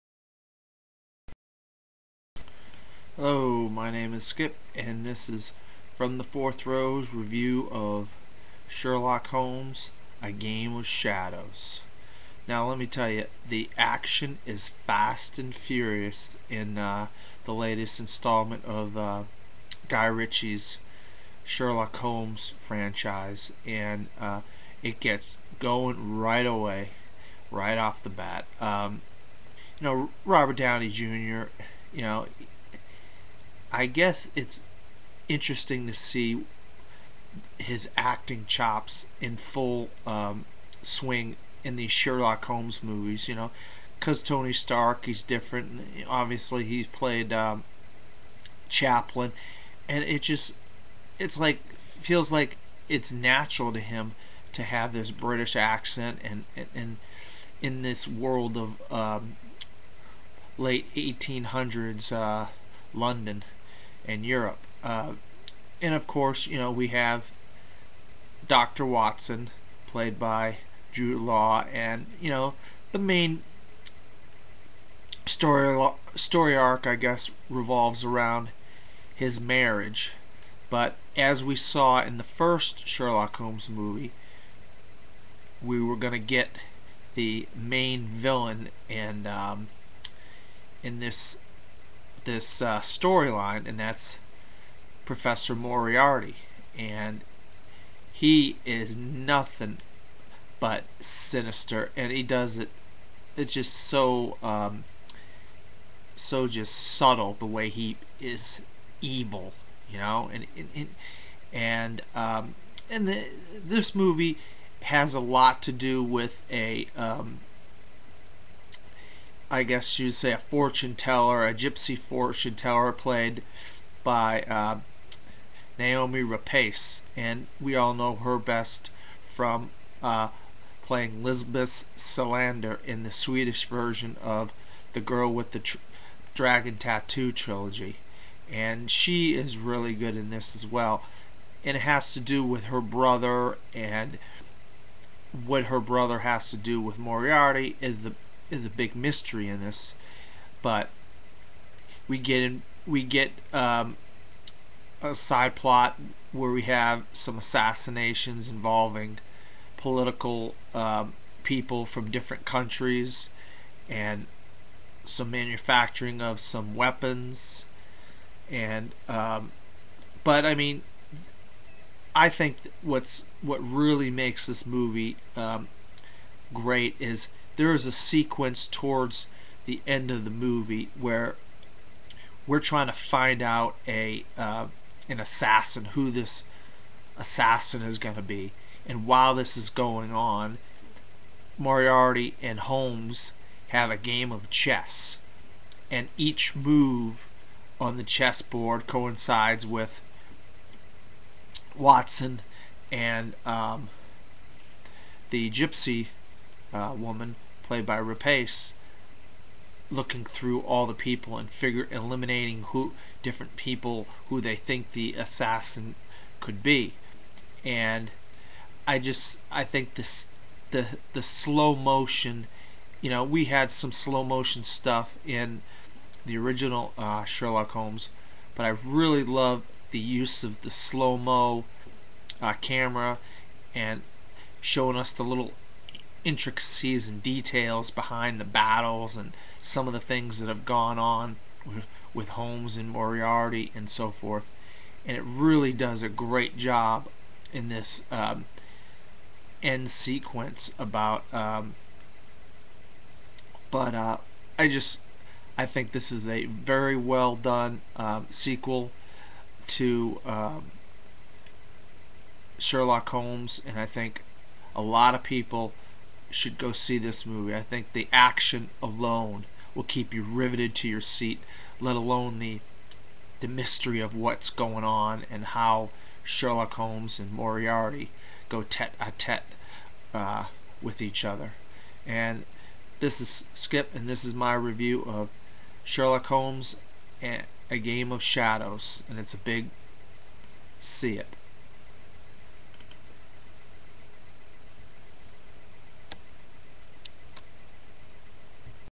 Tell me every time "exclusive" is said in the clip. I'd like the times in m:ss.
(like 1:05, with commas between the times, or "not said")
not said.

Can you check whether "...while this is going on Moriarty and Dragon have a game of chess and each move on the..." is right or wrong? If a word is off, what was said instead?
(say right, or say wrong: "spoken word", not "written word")
wrong: "Holmes", not "Dragon".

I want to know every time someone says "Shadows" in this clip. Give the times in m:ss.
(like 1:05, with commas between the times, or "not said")
0:10, 4:48.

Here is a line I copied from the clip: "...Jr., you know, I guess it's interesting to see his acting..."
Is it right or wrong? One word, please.
right.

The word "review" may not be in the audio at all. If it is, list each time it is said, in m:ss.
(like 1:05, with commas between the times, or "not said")
0:07, 4:44.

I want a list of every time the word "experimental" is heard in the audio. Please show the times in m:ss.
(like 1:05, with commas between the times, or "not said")
not said.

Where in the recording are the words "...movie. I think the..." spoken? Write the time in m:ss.
4:27.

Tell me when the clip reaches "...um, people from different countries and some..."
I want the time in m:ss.
2:40.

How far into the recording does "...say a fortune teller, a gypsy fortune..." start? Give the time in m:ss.
2:00.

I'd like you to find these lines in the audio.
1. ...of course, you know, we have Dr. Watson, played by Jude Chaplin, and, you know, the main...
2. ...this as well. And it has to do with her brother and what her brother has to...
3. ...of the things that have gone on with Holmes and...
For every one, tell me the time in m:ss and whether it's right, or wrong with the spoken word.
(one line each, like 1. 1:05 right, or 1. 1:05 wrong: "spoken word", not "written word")
1. 1:05 wrong: "Law", not "Chaplin"
2. 2:20 right
3. 3:59 right.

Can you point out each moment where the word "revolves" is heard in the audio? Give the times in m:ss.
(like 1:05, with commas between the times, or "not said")
1:17.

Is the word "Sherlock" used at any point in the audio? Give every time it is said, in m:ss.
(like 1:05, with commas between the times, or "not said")
0:08, 0:21, 0:41, 1:22, 3:47, 4:22, 4:36, 4:45.